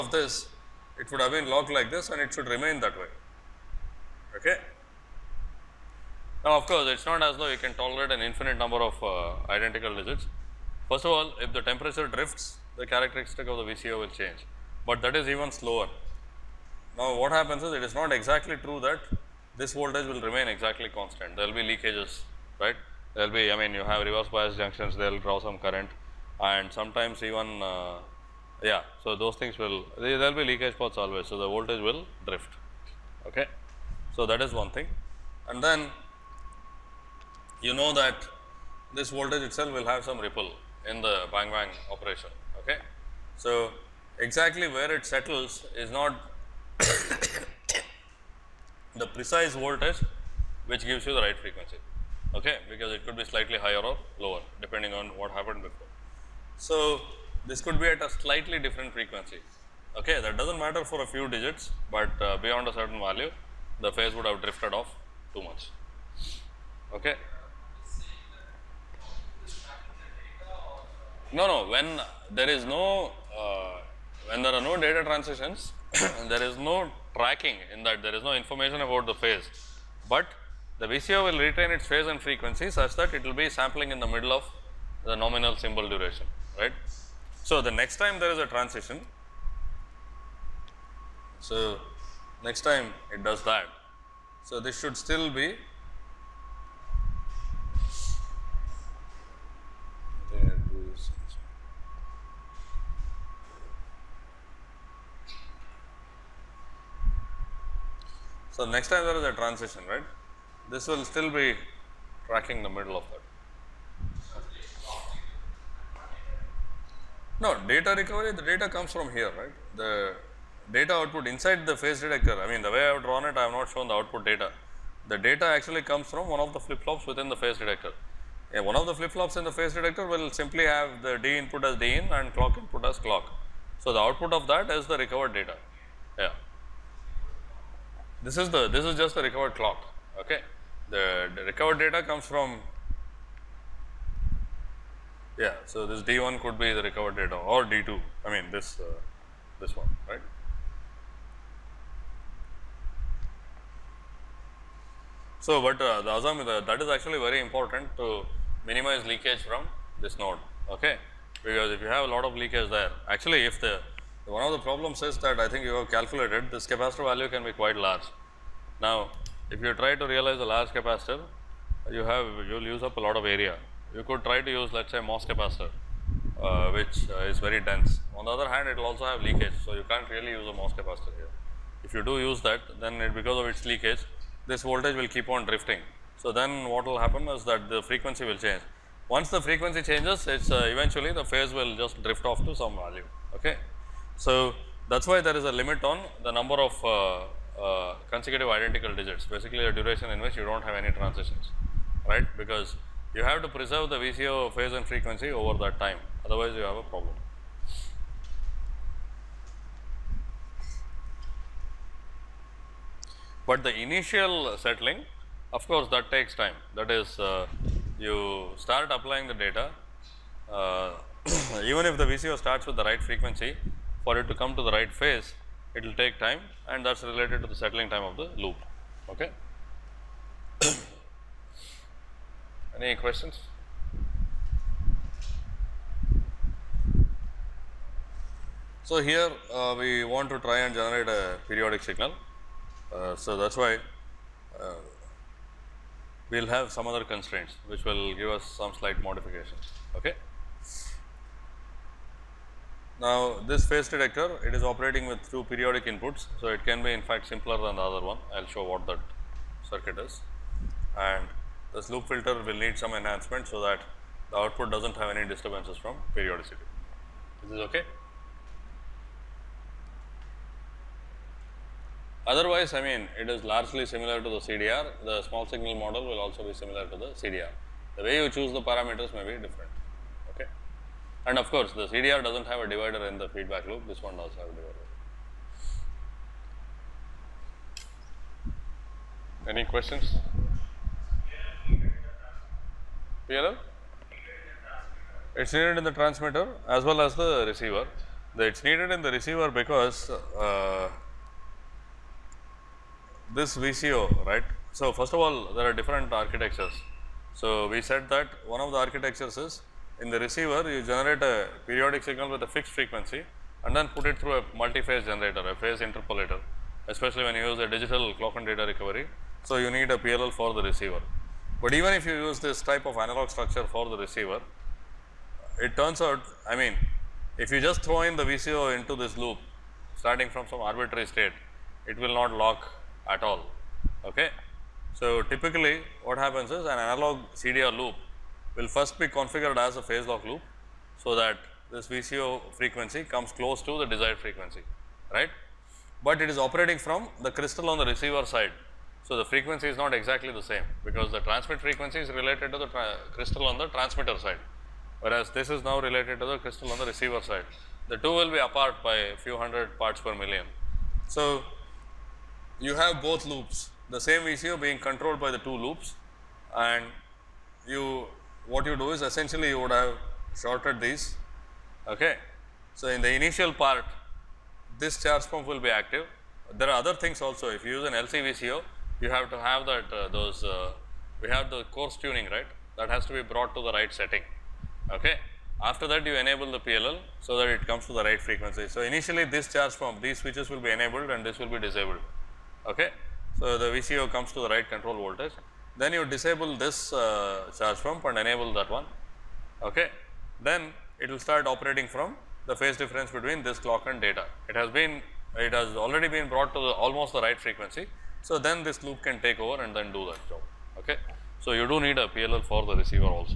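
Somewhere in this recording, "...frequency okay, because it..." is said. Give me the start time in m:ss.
0:51.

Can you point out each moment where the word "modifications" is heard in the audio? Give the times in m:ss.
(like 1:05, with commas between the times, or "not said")
4:09.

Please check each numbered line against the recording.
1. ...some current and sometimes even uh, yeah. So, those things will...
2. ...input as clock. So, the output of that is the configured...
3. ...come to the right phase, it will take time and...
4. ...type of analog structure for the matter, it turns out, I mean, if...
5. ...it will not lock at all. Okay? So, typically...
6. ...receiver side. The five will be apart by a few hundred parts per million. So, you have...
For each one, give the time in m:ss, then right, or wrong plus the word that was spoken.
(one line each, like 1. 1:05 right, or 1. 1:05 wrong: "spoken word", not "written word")
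1. 0:25 right
2. 2:12 wrong: "recovered", not "configured"
3. 3:44 right
4. 5:22 wrong: "receiver", not "matter"
5. 5:31 right
6. 5:56 wrong: "two", not "five".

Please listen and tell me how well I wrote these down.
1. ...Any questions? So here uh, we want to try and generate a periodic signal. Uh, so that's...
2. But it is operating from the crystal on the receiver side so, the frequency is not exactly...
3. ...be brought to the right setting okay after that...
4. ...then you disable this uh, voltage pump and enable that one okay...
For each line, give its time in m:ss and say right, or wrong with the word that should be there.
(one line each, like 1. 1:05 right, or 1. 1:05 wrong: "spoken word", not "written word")
1. 3:52 right
2. 5:46 right
3. 6:23 right
4. 6:35 wrong: "charge", not "voltage".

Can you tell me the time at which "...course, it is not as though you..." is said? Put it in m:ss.
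0:06.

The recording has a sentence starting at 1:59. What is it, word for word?
The data output inside the phase detector, I mean the way I have drawn it, I have not shown the output data.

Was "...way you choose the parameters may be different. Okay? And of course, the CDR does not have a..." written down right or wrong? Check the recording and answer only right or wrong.
right.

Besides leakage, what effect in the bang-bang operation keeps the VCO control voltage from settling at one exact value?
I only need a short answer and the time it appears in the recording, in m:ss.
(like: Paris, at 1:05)
Ripple, at 0:40.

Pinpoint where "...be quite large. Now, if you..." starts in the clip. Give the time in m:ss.
2:47.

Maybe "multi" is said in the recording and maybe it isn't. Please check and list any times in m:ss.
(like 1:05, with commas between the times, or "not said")
5:14.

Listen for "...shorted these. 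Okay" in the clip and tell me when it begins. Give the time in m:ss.
6:10.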